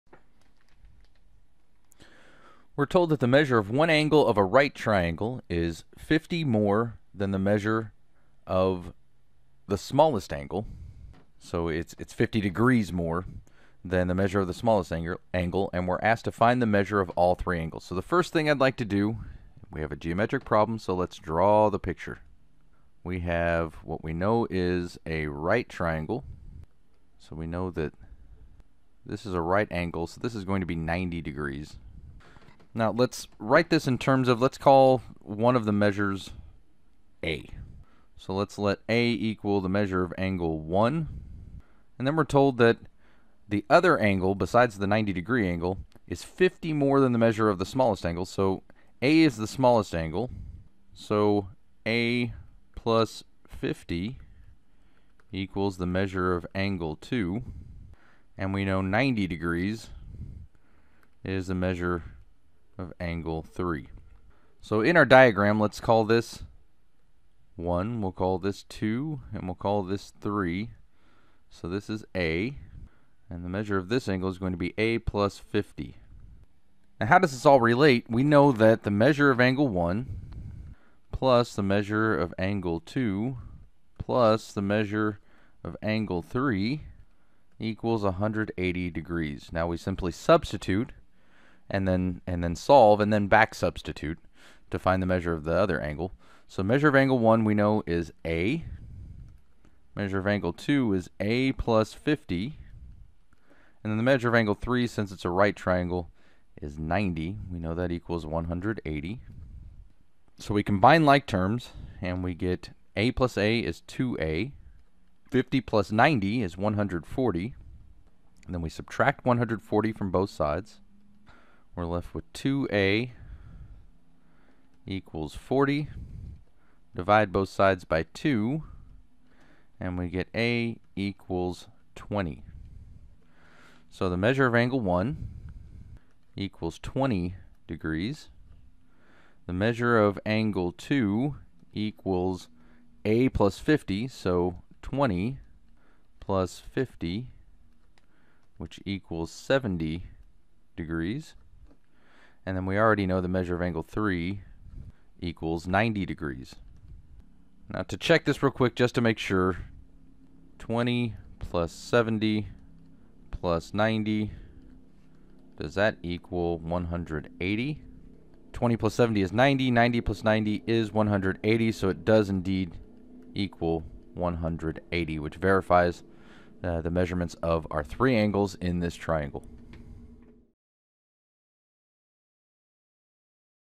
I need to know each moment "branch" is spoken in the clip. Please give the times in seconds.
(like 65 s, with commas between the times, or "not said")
not said.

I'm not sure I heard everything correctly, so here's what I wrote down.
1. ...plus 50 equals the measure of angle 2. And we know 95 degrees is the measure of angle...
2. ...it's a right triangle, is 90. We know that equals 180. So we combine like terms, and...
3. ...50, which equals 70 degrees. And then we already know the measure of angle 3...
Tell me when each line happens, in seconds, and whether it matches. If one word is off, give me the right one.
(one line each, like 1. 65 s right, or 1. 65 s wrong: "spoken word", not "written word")
1. 52 s wrong: "90", not "95"
2. 105 s right
3. 146 s right.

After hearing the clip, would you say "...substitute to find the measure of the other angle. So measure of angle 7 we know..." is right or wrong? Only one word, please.
wrong.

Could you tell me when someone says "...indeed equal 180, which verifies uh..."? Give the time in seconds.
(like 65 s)
172 s.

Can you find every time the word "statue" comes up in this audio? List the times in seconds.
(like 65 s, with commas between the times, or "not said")
not said.